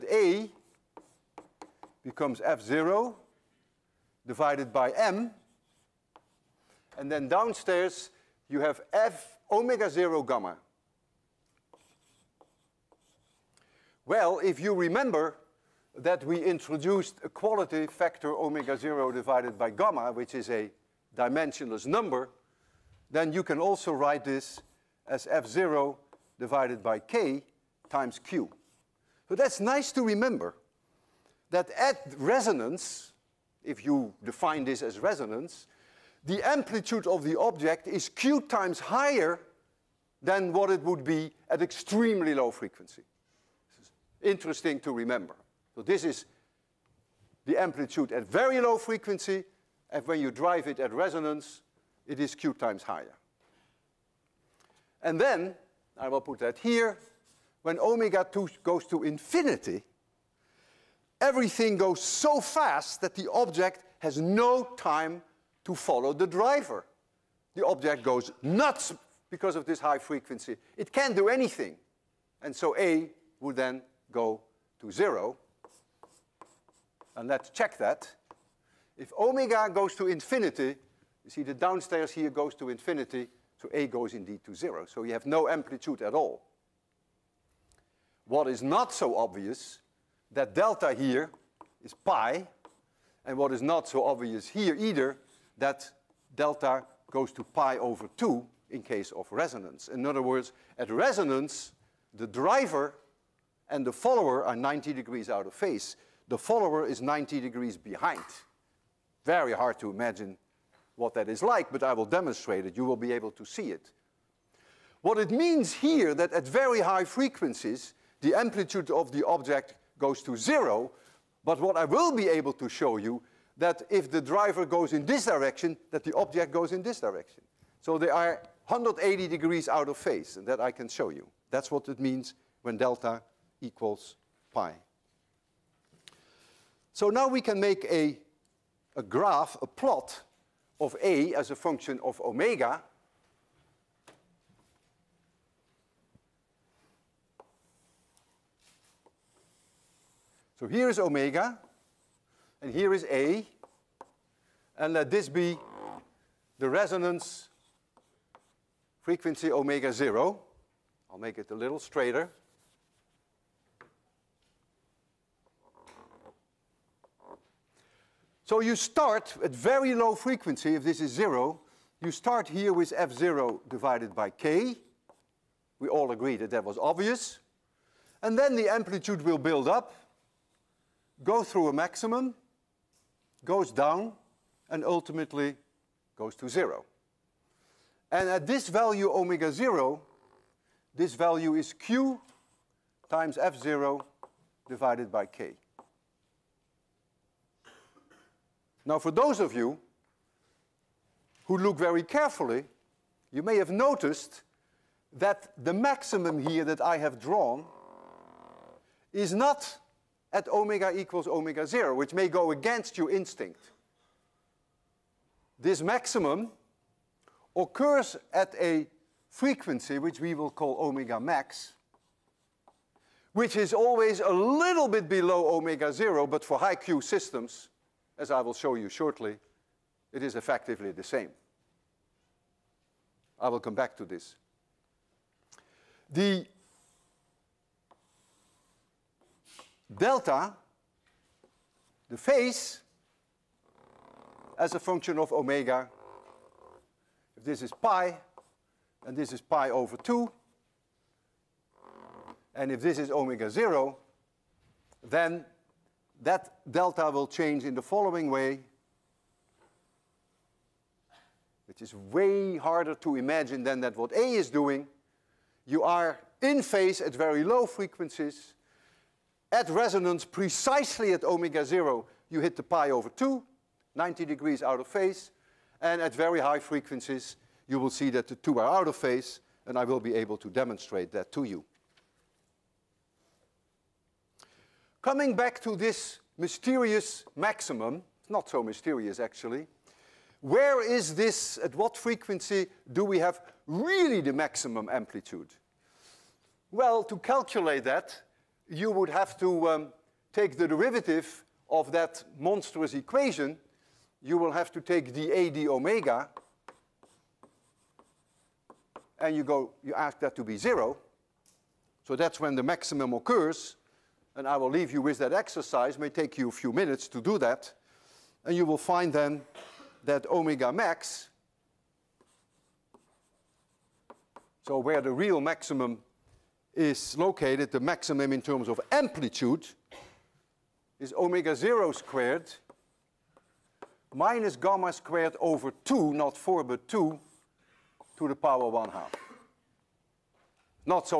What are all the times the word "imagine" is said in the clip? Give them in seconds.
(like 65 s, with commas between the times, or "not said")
109 s, 263 s.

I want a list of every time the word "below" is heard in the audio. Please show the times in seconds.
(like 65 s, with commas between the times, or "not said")
225 s.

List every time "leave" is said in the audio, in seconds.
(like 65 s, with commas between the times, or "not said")
314 s.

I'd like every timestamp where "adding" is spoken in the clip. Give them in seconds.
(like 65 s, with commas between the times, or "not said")
not said.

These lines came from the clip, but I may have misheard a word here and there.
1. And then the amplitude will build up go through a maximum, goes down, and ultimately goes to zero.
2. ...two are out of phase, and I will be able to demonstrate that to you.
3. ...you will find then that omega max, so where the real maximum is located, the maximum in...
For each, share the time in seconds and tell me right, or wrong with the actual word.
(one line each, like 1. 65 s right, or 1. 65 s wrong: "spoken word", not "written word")
1. 178 s right
2. 278 s right
3. 318 s right.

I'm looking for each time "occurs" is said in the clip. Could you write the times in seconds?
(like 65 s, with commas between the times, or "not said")
217 s, 313 s.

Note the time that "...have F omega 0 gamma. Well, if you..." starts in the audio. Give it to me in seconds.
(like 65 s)
8 s.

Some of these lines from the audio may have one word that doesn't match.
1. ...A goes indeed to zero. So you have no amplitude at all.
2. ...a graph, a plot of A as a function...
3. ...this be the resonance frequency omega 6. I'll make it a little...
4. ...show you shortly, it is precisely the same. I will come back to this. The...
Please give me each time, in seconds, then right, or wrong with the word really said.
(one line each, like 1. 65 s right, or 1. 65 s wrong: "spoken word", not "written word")
1. 83 s right
2. 138 s right
3. 155 s wrong: "0", not "6"
4. 228 s wrong: "effectively", not "precisely".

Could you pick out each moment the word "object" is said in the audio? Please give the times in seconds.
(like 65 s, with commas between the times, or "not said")
37 s, 63 s, 67 s, 119 s, 126 s.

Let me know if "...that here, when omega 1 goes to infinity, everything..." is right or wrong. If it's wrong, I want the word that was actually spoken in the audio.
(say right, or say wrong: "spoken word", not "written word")
wrong: "2", not "1".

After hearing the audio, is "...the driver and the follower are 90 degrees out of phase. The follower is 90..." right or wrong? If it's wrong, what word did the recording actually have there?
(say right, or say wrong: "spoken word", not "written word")
right.